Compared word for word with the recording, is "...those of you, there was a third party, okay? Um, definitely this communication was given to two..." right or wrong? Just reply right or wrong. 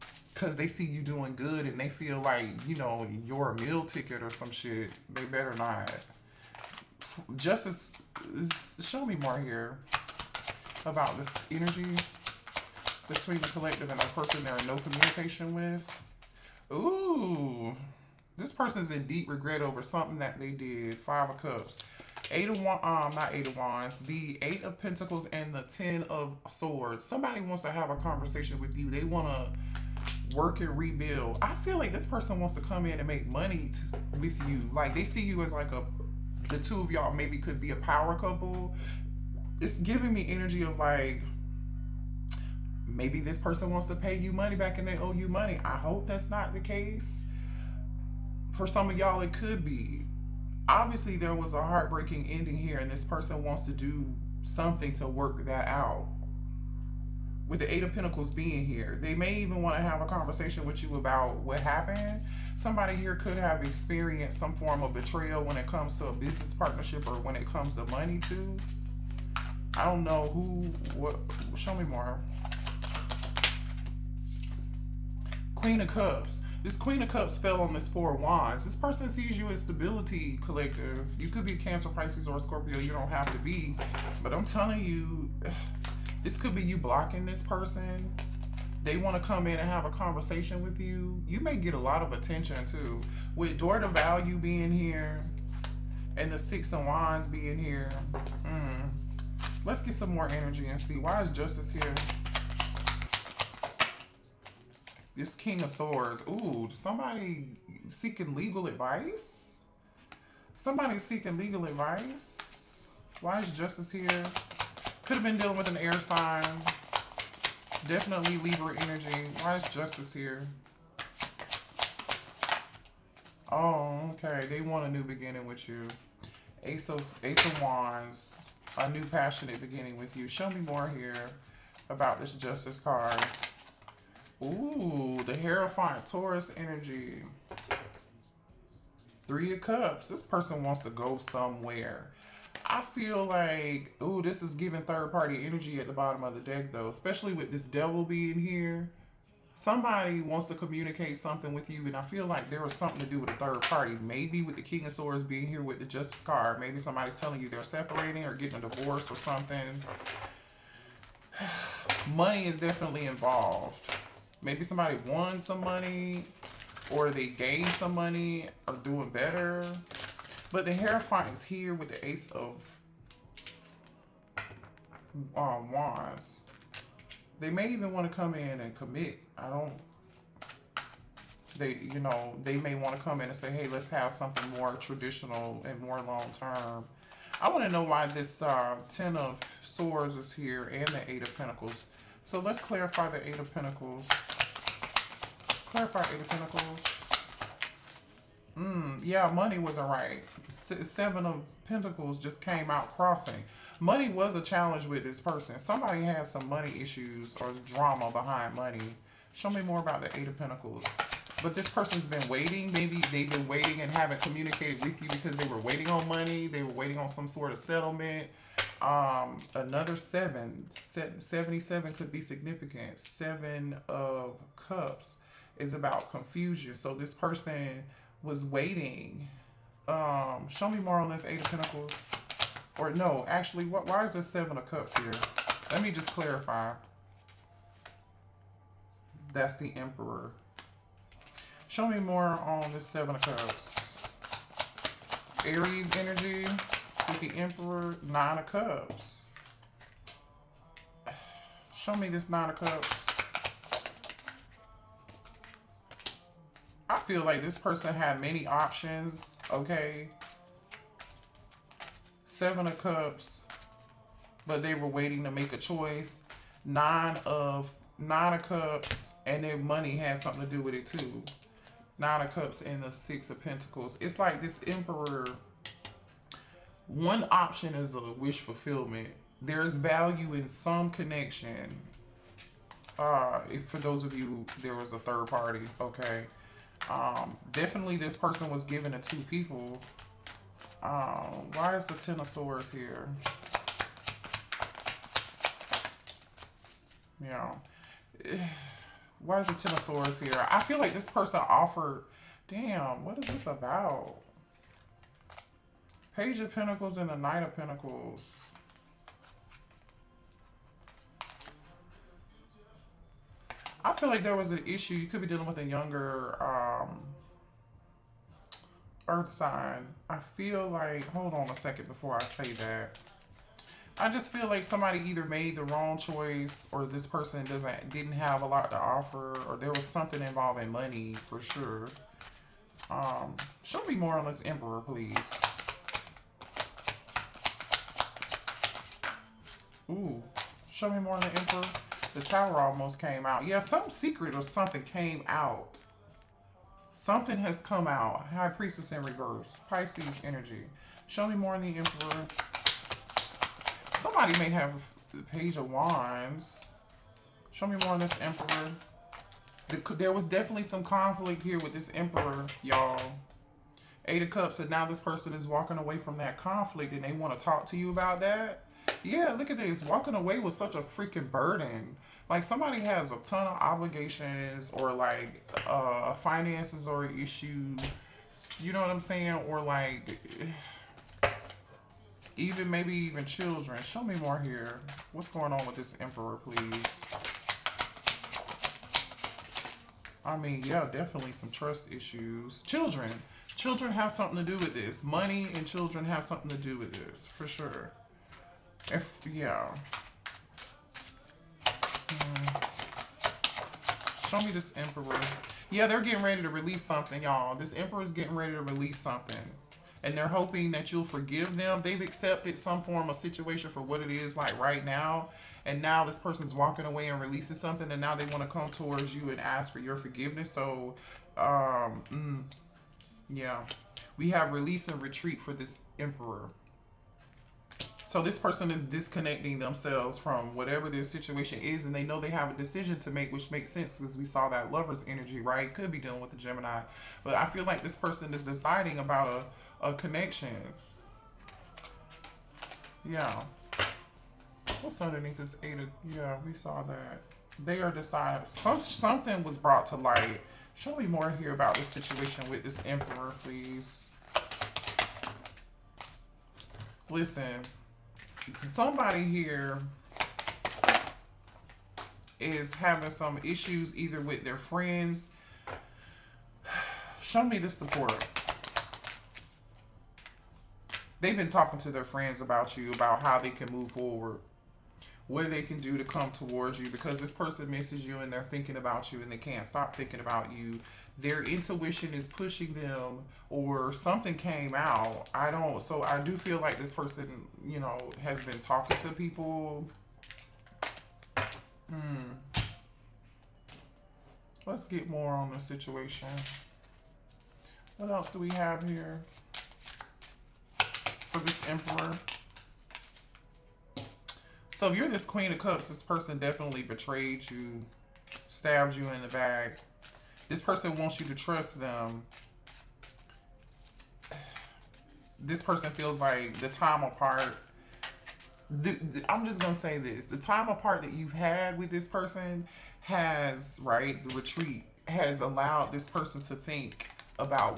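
wrong.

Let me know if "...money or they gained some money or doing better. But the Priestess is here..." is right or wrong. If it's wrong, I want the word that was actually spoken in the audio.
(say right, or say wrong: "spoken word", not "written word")
wrong: "Hierophant", not "Priestess".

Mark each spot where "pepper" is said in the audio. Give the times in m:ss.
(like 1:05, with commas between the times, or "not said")
not said.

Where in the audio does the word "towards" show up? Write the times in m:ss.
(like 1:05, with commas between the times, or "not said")
6:58, 7:56.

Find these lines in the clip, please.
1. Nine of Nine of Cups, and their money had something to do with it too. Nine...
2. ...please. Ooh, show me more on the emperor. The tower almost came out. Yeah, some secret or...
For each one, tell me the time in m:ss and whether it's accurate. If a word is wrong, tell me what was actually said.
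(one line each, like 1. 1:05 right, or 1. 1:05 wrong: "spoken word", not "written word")
1. 4:26 right
2. 5:34 right.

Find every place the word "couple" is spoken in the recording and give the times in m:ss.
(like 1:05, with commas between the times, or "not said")
0:38.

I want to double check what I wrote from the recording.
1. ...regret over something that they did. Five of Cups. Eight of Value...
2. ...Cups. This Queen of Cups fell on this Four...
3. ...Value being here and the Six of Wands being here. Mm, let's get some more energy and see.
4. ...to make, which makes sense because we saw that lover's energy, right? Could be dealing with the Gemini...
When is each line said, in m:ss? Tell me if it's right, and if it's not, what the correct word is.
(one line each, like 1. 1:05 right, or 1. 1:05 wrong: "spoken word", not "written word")
1. 0:19 wrong: "Wands", not "Value"
2. 1:15 right
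3. 1:33 right
4. 7:13 right.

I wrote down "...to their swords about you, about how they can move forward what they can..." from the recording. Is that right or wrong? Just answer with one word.
wrong.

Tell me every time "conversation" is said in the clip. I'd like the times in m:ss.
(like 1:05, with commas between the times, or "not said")
0:27, 1:00, 1:29.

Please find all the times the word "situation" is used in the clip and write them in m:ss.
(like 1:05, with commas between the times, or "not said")
6:53, 7:11, 7:31, 8:15.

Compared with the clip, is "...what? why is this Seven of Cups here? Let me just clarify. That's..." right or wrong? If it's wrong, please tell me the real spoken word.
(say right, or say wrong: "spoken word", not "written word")
right.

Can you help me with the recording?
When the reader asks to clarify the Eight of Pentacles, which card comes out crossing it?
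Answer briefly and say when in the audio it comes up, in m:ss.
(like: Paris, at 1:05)
Seven of Pentacles, at 3:20.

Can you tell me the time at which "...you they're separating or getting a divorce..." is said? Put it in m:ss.
2:37.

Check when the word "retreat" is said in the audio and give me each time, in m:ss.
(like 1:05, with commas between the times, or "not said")
7:05, 8:44.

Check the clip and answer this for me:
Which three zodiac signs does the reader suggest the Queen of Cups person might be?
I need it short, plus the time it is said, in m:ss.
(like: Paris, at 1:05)
Cancer, Pisces, or Scorpio, at 1:21.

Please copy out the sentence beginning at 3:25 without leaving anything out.
Somebody had some money issues or drama behind money.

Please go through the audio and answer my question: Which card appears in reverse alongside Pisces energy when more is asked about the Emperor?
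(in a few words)
High Priestess.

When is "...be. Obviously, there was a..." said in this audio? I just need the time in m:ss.
0:49.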